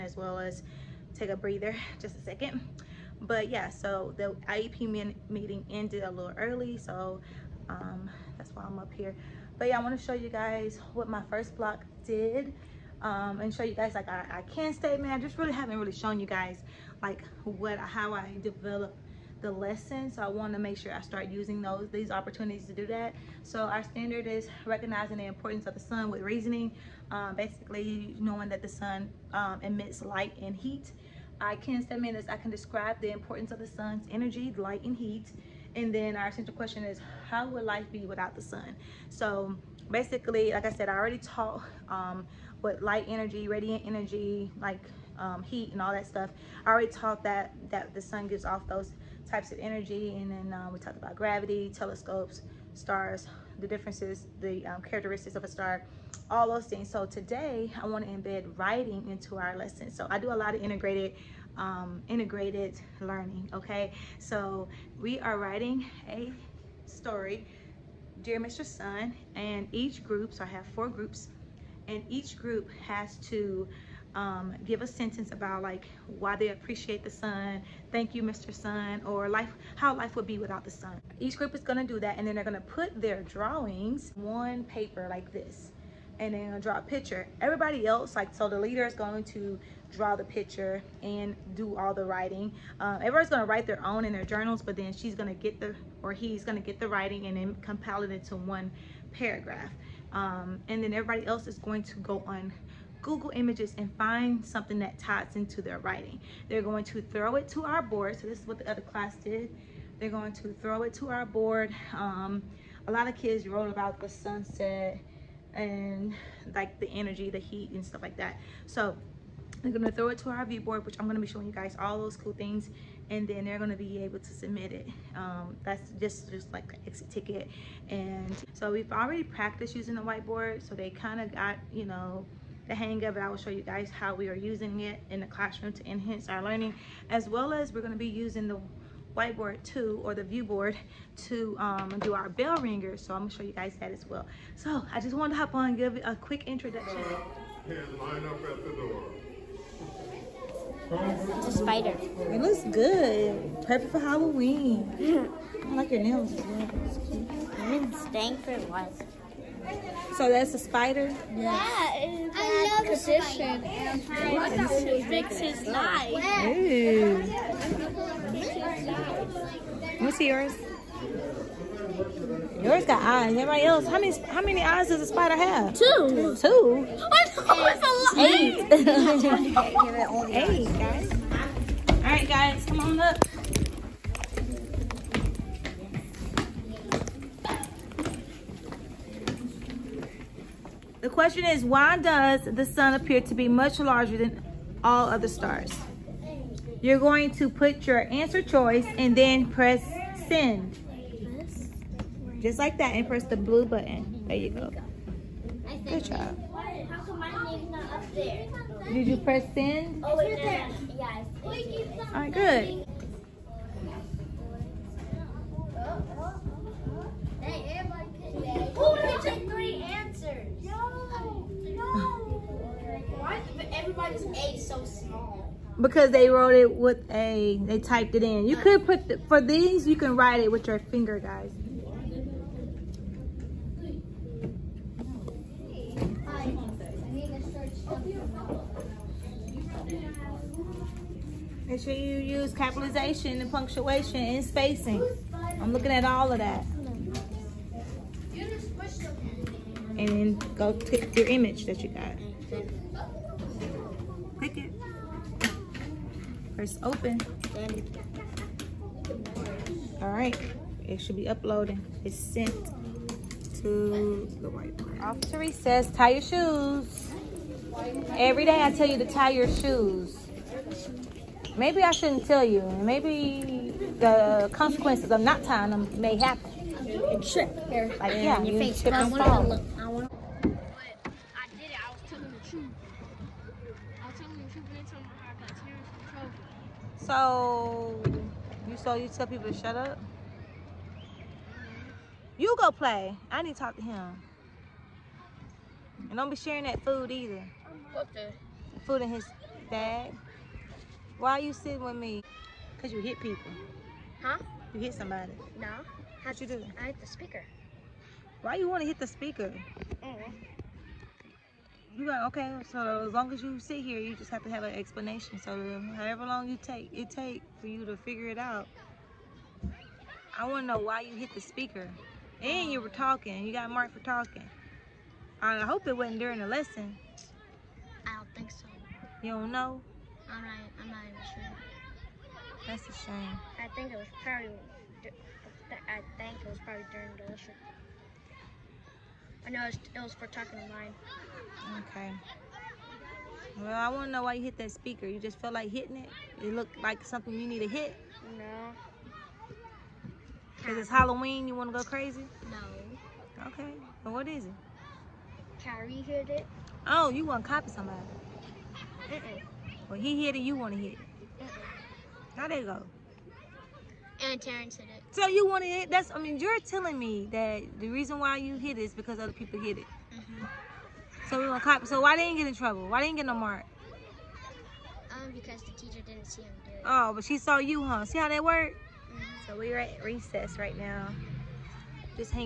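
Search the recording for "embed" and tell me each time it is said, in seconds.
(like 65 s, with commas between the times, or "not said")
58 s.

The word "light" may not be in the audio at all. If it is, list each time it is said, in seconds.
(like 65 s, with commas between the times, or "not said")
30 s, 34 s, 42 s.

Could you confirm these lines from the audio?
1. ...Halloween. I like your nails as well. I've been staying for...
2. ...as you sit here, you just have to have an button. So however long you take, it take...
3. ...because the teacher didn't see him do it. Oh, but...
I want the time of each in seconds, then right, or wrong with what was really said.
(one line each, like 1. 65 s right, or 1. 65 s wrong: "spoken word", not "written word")
1. 153 s right
2. 313 s wrong: "explanation", not "button"
3. 375 s right.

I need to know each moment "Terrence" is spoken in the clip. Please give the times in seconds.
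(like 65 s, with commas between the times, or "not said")
364 s.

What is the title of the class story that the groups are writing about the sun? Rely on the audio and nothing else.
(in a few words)
Dear Mr. Sun.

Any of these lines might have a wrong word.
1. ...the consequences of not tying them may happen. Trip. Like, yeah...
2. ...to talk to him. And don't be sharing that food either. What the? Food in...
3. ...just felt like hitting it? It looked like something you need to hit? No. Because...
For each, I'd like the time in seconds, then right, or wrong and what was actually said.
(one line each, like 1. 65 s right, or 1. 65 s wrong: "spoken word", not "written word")
1. 273 s right
2. 293 s right
3. 345 s right.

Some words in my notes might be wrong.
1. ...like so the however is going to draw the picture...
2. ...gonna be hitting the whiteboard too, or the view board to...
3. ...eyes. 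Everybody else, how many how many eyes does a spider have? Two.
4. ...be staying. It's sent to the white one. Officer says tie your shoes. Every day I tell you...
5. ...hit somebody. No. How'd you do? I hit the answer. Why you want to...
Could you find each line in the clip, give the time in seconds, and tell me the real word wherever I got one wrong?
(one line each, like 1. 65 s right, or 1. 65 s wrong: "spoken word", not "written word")
1. 88 s wrong: "leader", not "however"
2. 137 s wrong: "using", not "hitting"
3. 173 s right
4. 261 s wrong: "uploading", not "staying"
5. 304 s wrong: "speaker", not "answer".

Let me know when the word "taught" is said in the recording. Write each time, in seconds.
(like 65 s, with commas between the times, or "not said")
41 s, 46 s.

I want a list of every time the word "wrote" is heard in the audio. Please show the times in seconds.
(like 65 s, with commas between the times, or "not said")
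113 s, 226 s.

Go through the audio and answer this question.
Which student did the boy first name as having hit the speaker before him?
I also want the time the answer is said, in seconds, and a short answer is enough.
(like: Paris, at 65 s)
Kyrie, at 355 s.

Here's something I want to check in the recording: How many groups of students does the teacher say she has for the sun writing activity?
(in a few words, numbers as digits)
4.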